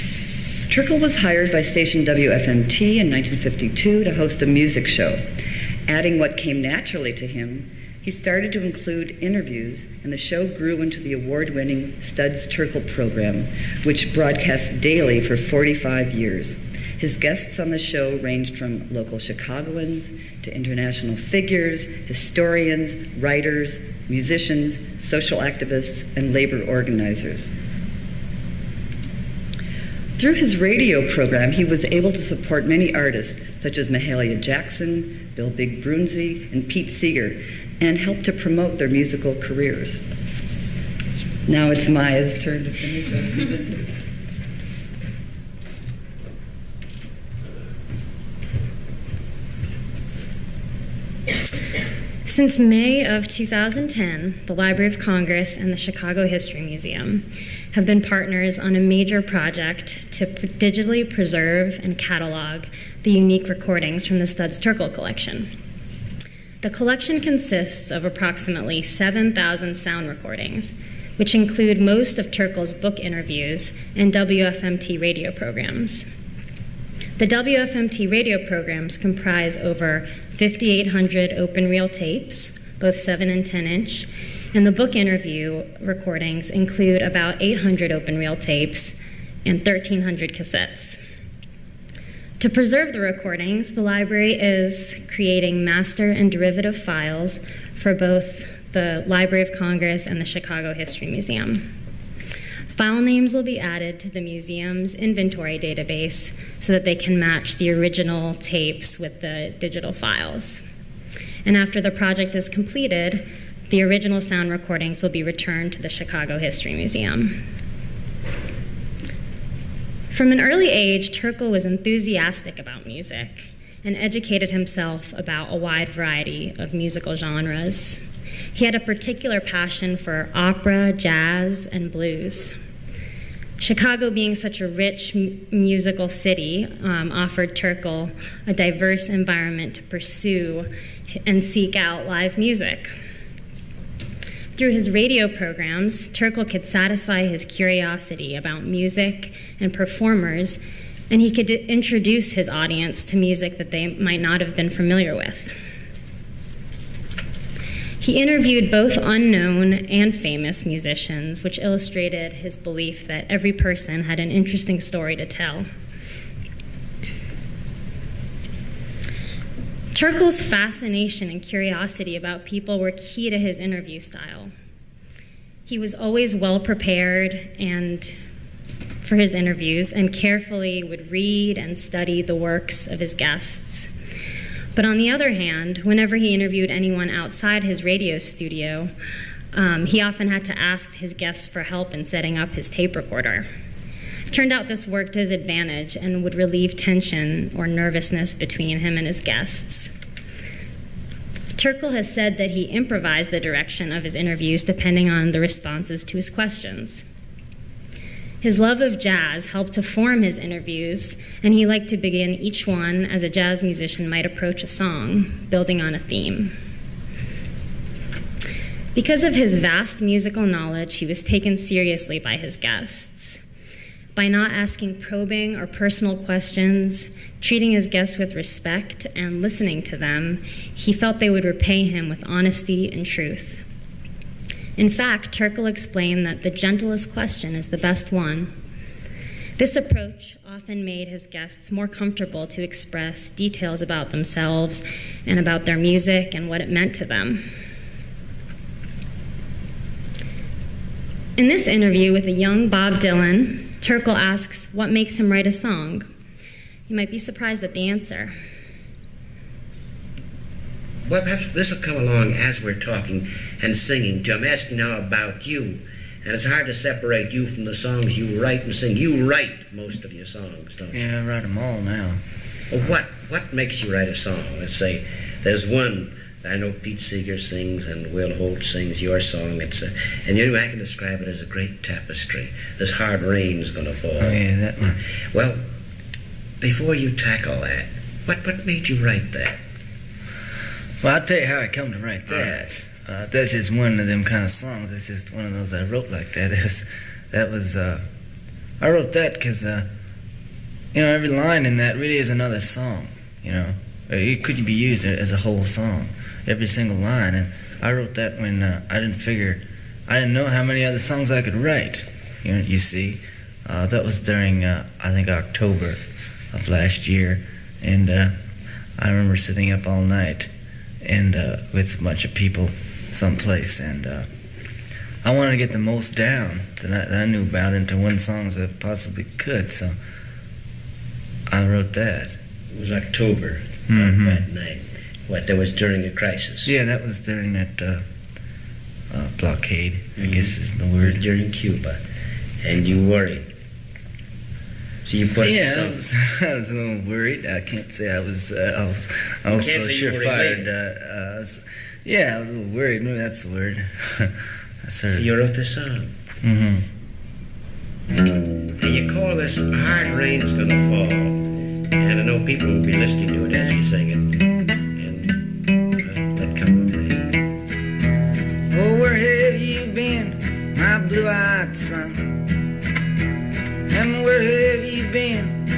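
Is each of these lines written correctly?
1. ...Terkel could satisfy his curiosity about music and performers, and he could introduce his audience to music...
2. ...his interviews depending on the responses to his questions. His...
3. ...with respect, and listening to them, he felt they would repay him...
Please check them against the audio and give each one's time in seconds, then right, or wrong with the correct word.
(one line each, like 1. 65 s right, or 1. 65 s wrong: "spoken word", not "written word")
1. 146 s right
2. 204 s right
3. 228 s right.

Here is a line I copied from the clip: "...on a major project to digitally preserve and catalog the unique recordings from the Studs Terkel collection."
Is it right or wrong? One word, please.
right.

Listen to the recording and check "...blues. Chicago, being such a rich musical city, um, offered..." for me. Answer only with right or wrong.
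right.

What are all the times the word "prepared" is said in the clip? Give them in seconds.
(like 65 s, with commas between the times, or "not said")
176 s.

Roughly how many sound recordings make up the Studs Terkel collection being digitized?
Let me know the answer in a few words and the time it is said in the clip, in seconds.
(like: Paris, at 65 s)
7,000, at 68 s.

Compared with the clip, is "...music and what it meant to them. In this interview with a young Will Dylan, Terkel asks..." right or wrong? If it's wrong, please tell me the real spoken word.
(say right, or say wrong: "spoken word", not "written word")
wrong: "Bob", not "Will".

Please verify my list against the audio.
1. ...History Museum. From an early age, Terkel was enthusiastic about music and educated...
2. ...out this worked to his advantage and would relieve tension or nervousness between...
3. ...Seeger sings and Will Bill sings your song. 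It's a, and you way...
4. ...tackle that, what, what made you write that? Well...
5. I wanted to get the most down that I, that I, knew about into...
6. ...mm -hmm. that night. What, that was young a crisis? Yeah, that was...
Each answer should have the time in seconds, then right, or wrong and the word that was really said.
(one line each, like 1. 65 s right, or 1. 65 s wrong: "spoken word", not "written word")
1. 116 s right
2. 194 s right
3. 276 s wrong: "Holt", not "Bill"
4. 287 s right
5. 325 s right
6. 333 s wrong: "during", not "young".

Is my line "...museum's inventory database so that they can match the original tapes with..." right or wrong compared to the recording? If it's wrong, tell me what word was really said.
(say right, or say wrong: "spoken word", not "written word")
right.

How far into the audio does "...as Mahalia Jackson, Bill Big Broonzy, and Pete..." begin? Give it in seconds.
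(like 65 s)
33 s.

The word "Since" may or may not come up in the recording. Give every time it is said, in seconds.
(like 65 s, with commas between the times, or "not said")
52 s.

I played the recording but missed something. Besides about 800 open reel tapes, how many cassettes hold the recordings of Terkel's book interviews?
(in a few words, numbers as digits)
1,300.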